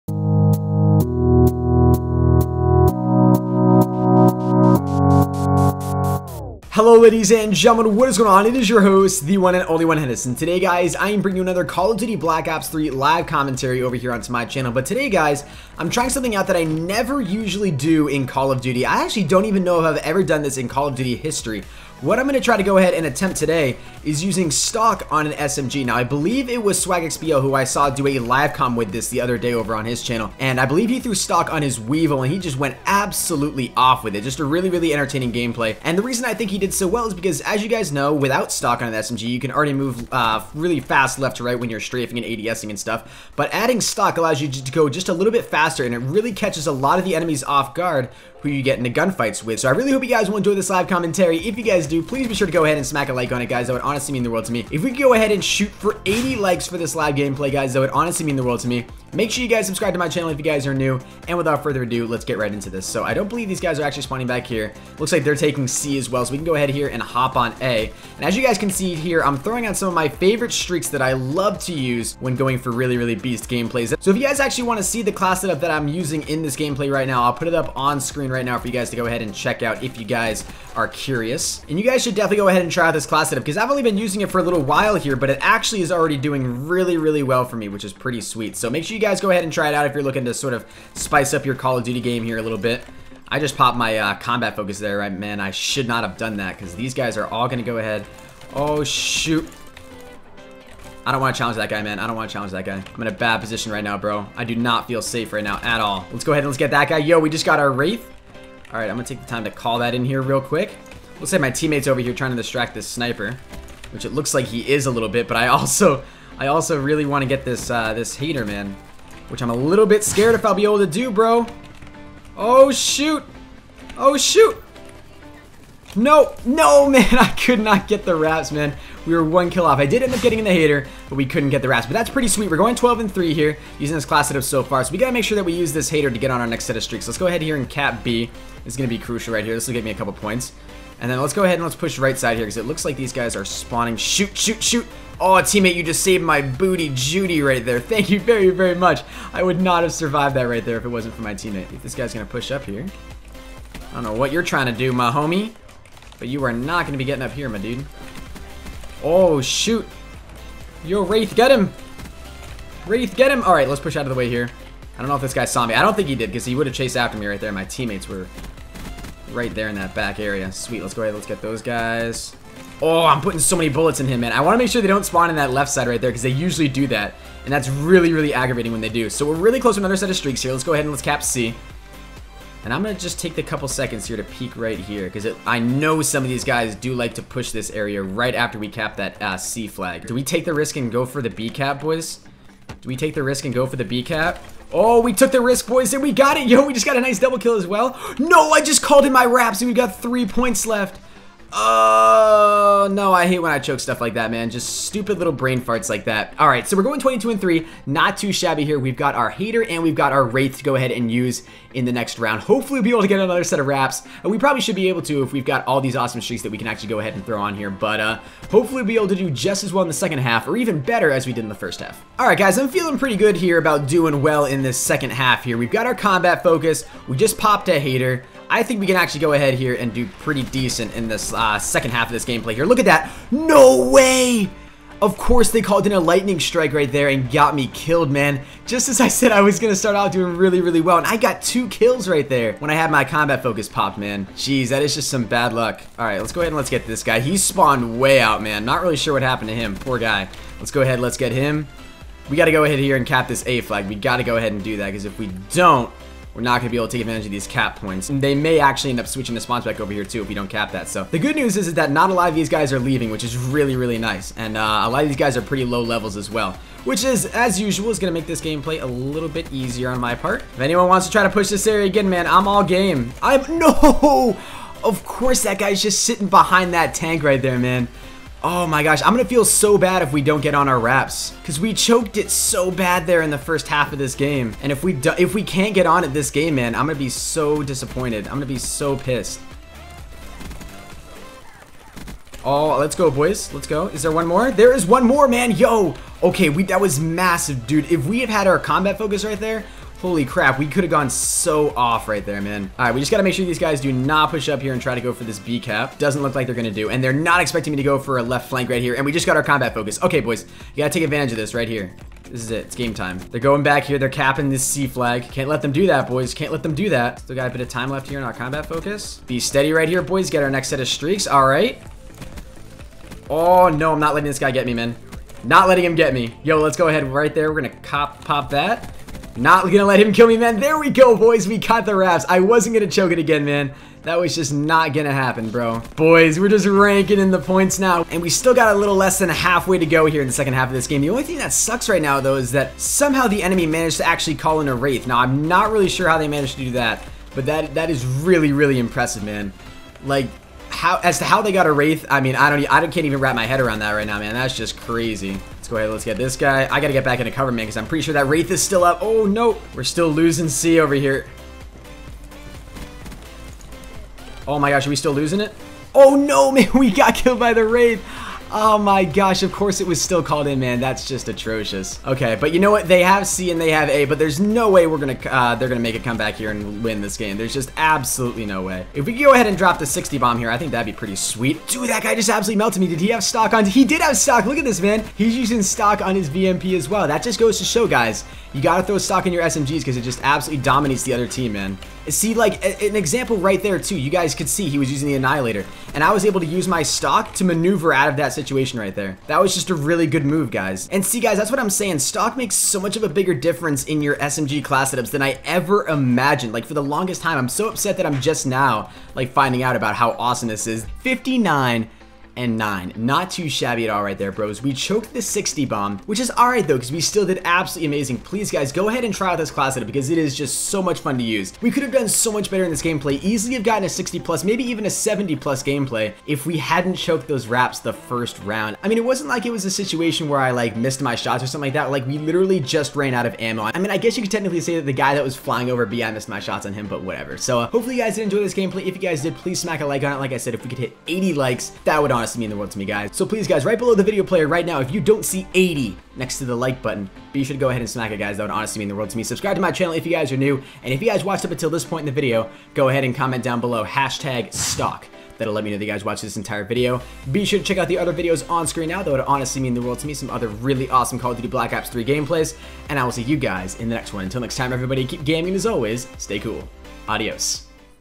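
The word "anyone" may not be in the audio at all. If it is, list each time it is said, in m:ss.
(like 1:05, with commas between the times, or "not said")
4:30.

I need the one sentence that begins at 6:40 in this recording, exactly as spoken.
And see, guys, that's what I'm saying.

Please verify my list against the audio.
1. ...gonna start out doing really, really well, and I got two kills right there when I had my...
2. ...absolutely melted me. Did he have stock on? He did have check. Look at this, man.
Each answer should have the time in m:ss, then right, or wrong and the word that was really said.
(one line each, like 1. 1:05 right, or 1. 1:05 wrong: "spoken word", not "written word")
1. 3:59 right
2. 6:22 wrong: "stock", not "check".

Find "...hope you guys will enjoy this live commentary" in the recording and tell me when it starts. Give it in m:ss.
0:49.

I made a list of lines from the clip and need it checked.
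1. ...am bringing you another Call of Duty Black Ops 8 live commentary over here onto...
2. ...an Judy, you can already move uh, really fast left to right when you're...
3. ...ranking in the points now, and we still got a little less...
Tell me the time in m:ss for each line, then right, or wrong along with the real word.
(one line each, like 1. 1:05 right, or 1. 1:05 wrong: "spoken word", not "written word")
1. 0:11 wrong: "3", not "8"
2. 0:38 wrong: "SMG", not "Judy"
3. 5:36 right.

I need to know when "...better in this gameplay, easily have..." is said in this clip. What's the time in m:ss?
7:02.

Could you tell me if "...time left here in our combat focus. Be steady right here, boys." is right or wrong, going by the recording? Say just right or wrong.
right.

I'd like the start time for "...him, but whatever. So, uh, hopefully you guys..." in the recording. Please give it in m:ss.
7:16.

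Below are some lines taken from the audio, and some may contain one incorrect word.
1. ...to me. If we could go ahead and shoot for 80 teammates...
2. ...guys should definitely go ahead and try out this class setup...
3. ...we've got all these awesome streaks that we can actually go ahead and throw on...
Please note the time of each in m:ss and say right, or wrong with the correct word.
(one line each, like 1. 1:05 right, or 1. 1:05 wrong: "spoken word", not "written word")
1. 0:54 wrong: "likes", not "teammates"
2. 1:21 right
3. 3:35 right.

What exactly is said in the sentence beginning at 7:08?
I mean, it wasn't like it was a situation where I, like, missed my shots or something like that.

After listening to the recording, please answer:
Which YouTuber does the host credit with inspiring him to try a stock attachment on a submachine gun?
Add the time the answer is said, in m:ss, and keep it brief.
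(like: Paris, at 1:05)
SwagXPO, at 0:26.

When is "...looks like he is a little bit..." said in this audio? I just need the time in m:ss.
1:54.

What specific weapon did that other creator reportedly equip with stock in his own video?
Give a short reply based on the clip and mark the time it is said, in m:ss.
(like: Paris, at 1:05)
Weevil, at 0:31.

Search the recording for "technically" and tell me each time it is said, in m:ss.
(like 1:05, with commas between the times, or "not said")
7:14.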